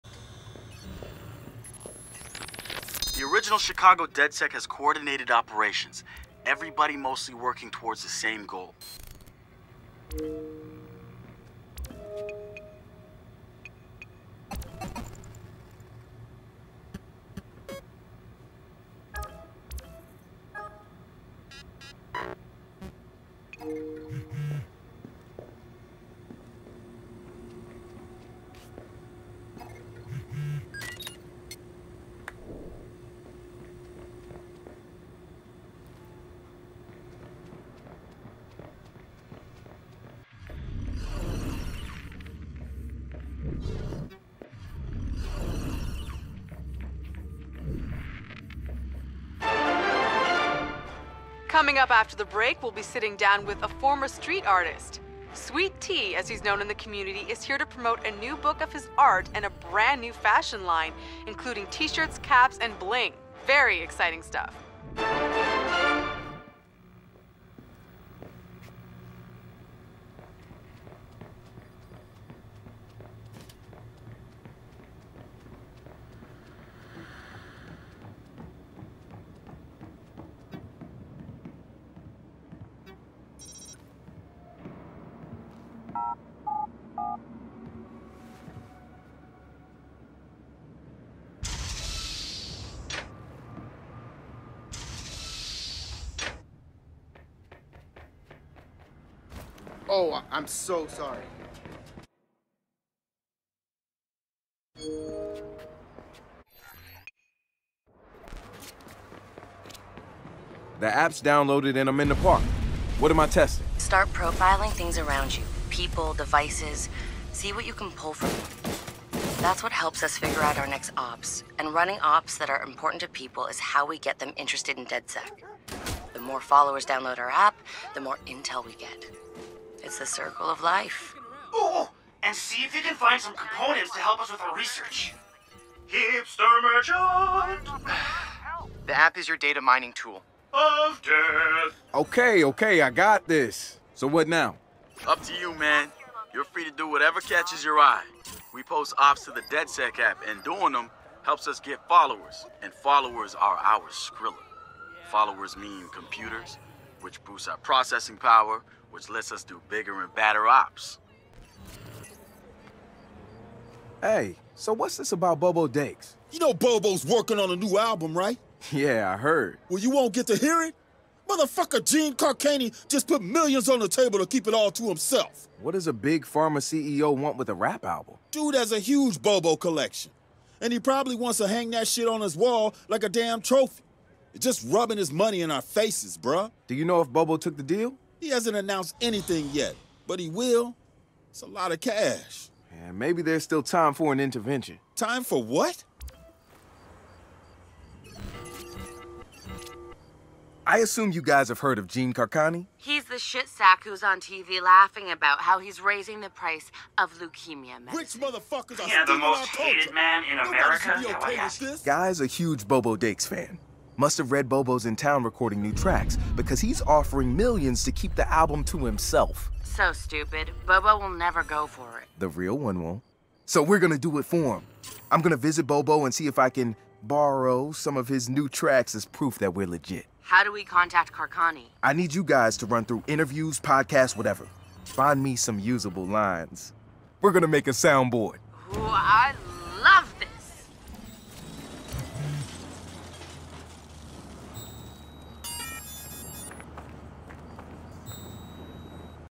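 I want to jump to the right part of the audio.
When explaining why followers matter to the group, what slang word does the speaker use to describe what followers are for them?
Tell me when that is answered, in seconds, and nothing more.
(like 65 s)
153 s.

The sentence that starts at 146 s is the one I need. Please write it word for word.
You're free to do whatever catches your eye.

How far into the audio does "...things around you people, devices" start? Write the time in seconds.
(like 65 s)
114 s.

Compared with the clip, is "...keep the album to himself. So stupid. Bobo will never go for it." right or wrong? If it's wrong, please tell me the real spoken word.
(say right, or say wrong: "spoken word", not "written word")
right.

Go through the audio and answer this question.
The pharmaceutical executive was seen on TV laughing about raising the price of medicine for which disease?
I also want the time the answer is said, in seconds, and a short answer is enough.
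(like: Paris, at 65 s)
leukemia, at 207 s.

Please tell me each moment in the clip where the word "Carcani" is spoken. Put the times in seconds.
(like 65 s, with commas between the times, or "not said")
172 s, 202 s, 231 s.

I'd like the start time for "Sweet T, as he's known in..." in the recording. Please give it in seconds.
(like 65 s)
55 s.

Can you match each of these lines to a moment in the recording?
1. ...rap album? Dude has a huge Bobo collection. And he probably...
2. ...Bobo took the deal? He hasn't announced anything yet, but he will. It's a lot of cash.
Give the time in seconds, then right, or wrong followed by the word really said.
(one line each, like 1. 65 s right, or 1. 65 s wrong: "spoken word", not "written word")
1. 177 s right
2. 187 s right.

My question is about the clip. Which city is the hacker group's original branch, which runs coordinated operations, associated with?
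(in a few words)
Chicago.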